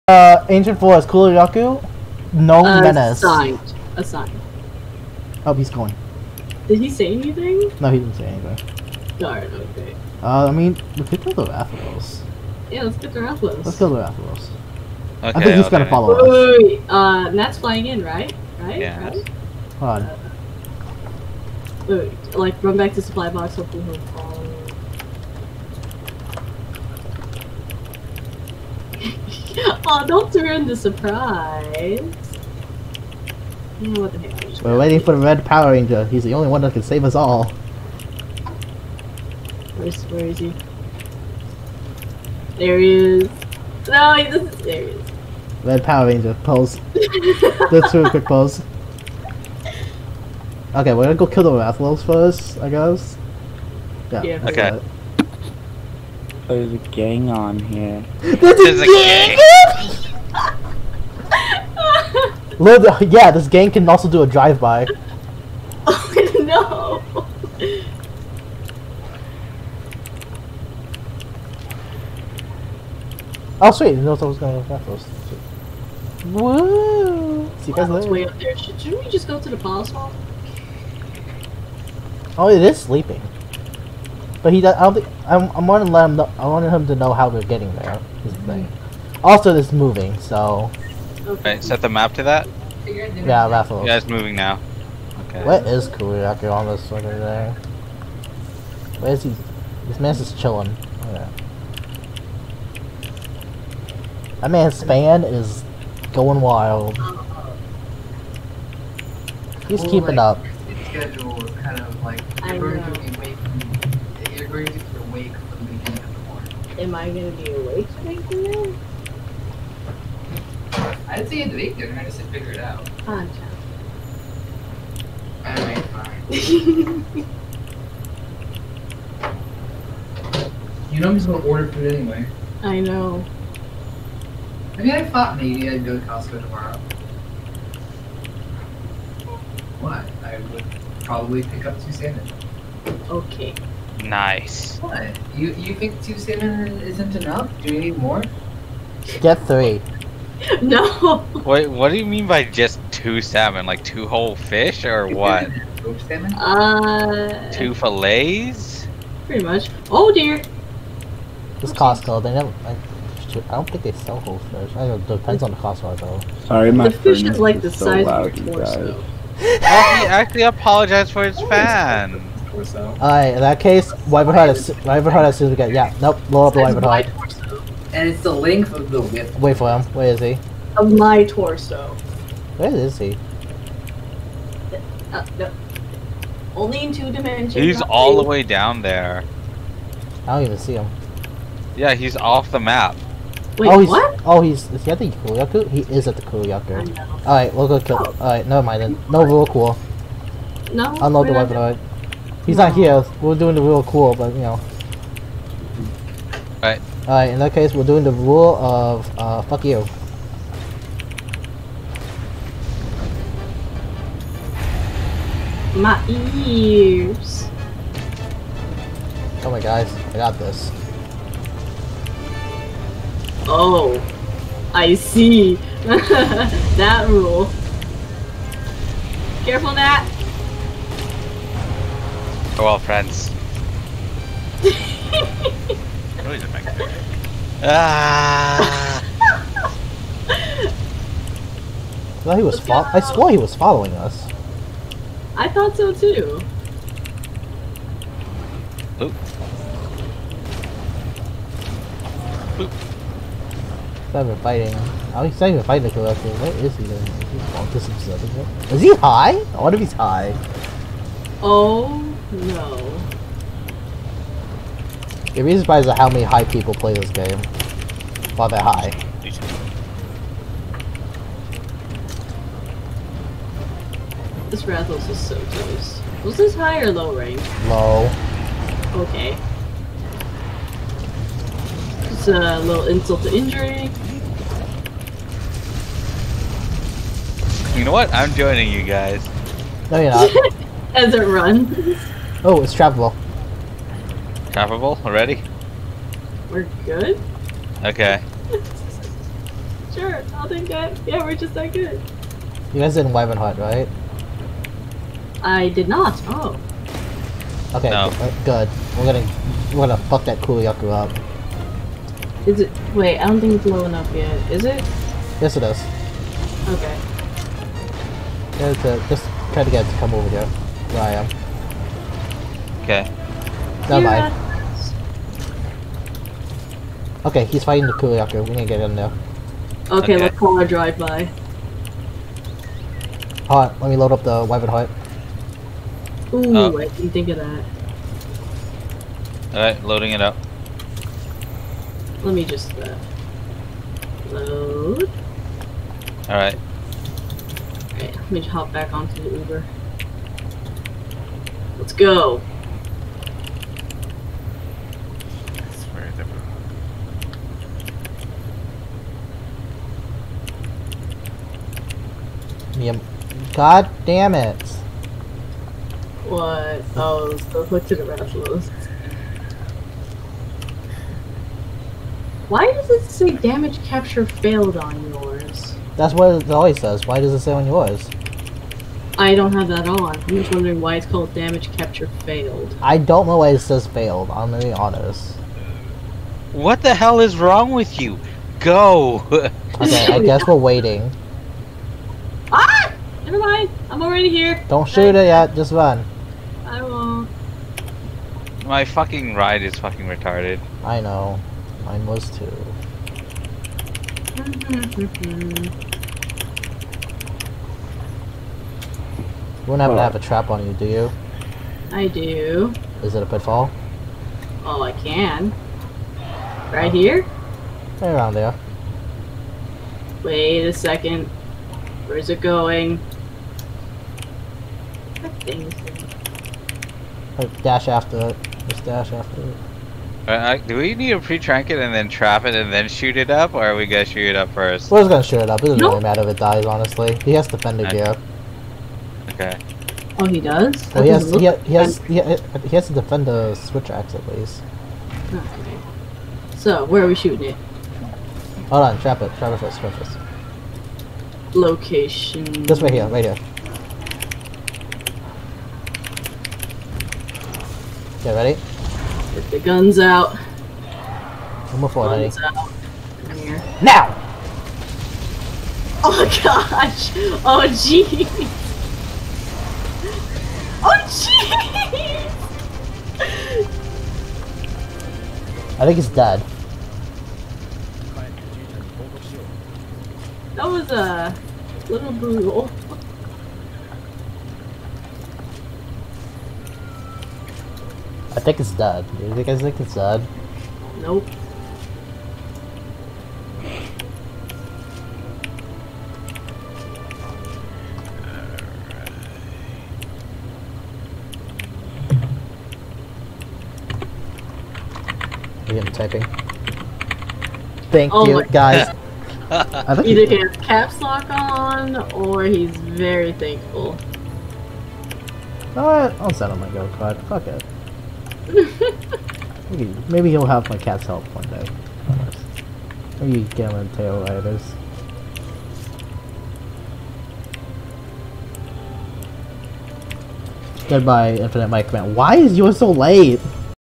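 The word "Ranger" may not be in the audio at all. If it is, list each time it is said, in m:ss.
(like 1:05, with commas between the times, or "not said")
0:35, 0:46.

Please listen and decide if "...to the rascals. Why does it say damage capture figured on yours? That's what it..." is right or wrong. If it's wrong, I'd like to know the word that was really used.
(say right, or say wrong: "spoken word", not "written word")
wrong: "failed", not "figured".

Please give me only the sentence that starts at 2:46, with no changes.
Sorry, my the fish is like the size so of a torso.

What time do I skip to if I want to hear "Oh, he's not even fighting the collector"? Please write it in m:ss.
4:15.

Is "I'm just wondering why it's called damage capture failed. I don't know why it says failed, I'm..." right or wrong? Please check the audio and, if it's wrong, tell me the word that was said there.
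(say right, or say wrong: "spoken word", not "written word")
right.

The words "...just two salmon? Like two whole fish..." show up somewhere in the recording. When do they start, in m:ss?
2:32.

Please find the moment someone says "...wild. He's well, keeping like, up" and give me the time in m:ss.
1:46.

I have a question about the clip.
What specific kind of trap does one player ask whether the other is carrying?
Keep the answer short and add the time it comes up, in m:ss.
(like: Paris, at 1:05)
pitfall, at 6:53.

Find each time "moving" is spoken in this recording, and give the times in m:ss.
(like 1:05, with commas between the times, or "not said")
1:29, 1:34.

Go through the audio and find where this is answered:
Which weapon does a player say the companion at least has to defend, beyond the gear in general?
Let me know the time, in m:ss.
7:23.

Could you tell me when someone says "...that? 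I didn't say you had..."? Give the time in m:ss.
2:00.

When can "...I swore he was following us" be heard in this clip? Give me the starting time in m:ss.
4:02.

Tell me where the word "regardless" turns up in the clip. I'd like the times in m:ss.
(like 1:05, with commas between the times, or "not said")
not said.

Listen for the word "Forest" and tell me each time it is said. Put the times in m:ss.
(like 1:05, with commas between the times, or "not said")
0:00.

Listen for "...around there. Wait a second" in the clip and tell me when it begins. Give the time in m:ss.
6:58.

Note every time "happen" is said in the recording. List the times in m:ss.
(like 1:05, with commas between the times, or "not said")
6:49.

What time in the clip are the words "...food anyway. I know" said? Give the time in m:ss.
2:11.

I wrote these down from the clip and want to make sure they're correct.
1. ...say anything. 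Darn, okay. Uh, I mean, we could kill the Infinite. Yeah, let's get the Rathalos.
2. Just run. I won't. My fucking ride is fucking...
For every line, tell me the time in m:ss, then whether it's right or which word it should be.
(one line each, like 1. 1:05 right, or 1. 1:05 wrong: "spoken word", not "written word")
1. 0:08 wrong: "Rathalos", not "Infinite"
2. 6:35 right.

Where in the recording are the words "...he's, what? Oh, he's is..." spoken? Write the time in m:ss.
3:13.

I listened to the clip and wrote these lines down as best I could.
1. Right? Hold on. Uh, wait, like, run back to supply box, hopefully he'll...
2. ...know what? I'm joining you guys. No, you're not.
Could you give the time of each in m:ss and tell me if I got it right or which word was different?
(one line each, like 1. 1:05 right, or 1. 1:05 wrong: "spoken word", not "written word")
1. 0:19 right
2. 4:47 right.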